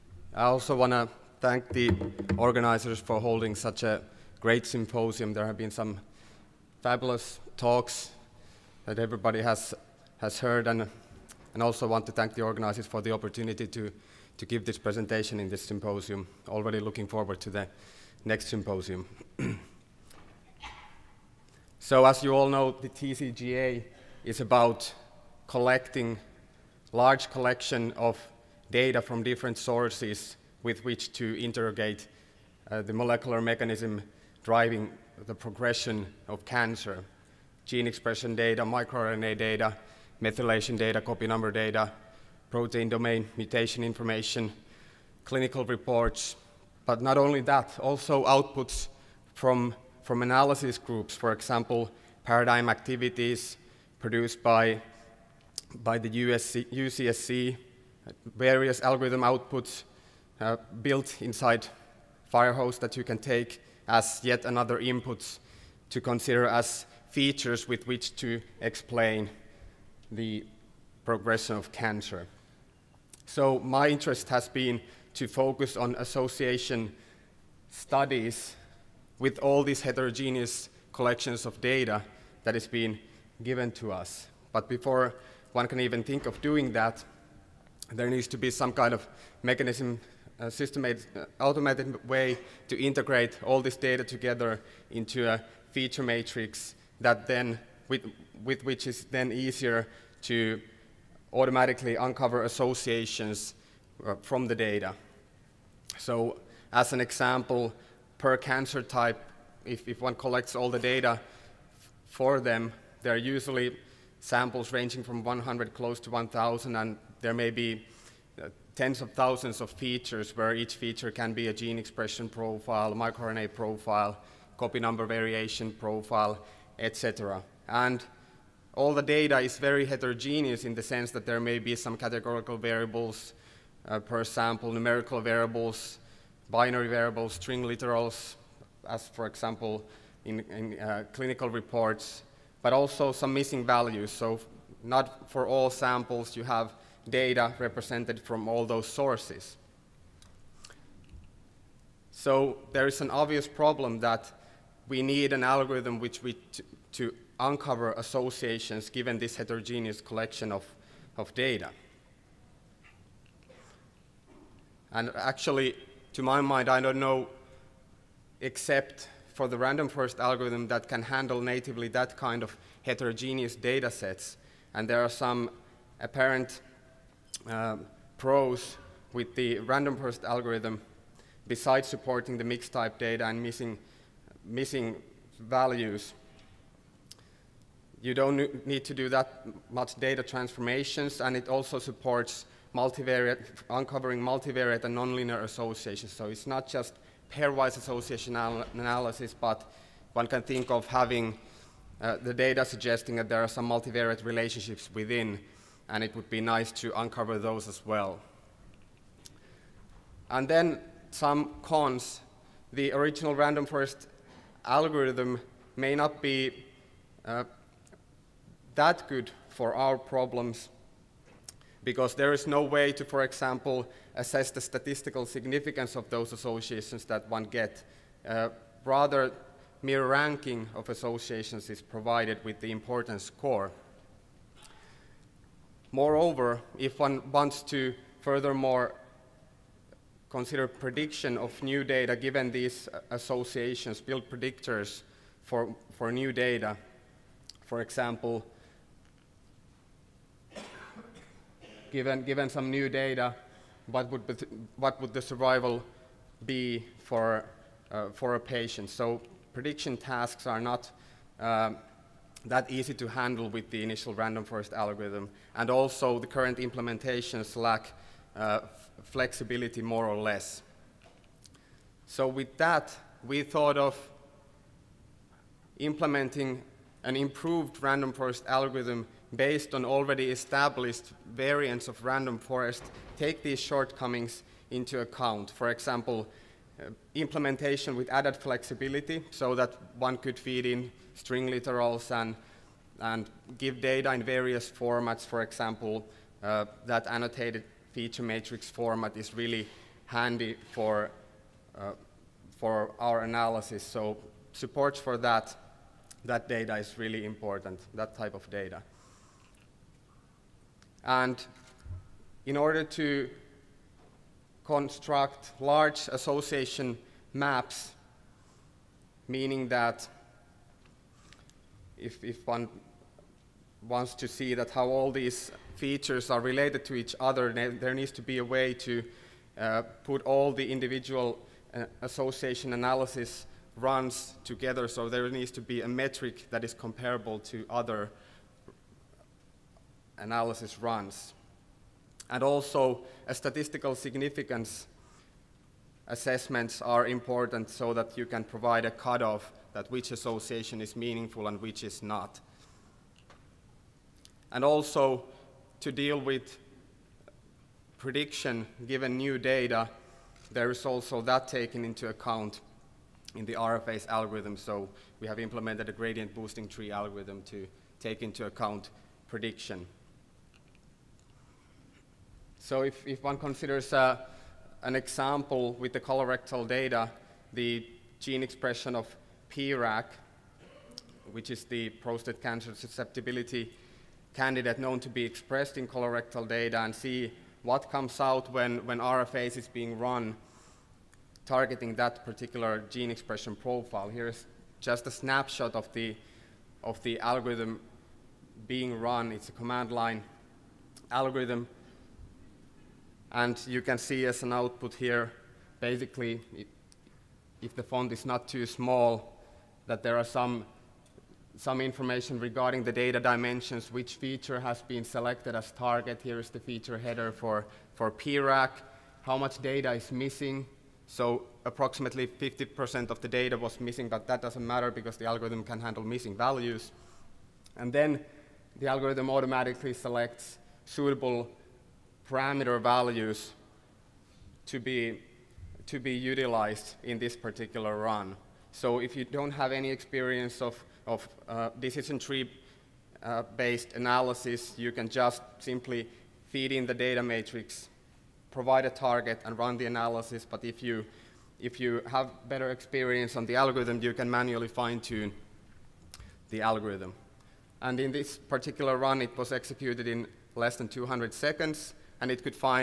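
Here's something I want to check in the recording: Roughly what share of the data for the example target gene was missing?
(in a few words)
50%.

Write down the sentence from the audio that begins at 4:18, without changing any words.
So prediction tasks are not um, that easy to handle with the initial random forest algorithm.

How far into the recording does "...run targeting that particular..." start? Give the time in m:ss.
6:29.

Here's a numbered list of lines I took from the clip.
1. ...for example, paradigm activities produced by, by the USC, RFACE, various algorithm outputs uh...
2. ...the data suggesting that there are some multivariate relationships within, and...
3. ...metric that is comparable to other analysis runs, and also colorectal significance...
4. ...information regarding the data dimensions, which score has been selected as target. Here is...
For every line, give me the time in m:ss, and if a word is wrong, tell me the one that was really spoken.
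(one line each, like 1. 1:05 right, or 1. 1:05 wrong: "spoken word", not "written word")
1. 0:51 wrong: "UCSC", not "RFACE"
2. 3:22 right
3. 5:35 wrong: "statistical", not "colorectal"
4. 6:51 wrong: "feature", not "score".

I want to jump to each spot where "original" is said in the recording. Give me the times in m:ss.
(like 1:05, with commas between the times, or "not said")
3:32.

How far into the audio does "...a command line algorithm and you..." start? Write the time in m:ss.
6:39.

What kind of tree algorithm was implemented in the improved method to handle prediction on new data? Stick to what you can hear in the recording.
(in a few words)
Gradient boosting tree.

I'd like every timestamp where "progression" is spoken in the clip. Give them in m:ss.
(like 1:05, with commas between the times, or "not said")
0:35, 1:11.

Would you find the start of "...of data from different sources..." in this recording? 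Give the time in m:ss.
0:27.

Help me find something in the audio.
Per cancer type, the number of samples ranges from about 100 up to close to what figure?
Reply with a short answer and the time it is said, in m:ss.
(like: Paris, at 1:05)
1,000, at 1:56.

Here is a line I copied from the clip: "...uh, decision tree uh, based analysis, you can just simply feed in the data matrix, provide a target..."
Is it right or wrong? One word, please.
right.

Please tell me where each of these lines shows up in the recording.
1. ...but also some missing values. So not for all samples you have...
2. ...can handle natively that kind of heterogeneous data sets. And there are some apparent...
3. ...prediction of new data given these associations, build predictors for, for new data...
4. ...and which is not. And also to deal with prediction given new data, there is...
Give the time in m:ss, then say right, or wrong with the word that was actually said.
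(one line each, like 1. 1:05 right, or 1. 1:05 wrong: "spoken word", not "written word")
1. 2:22 right
2. 2:50 right
3. 4:00 right
4. 5:51 right.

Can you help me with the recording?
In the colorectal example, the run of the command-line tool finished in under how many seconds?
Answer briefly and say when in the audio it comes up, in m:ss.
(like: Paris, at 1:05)
200, at 7:40.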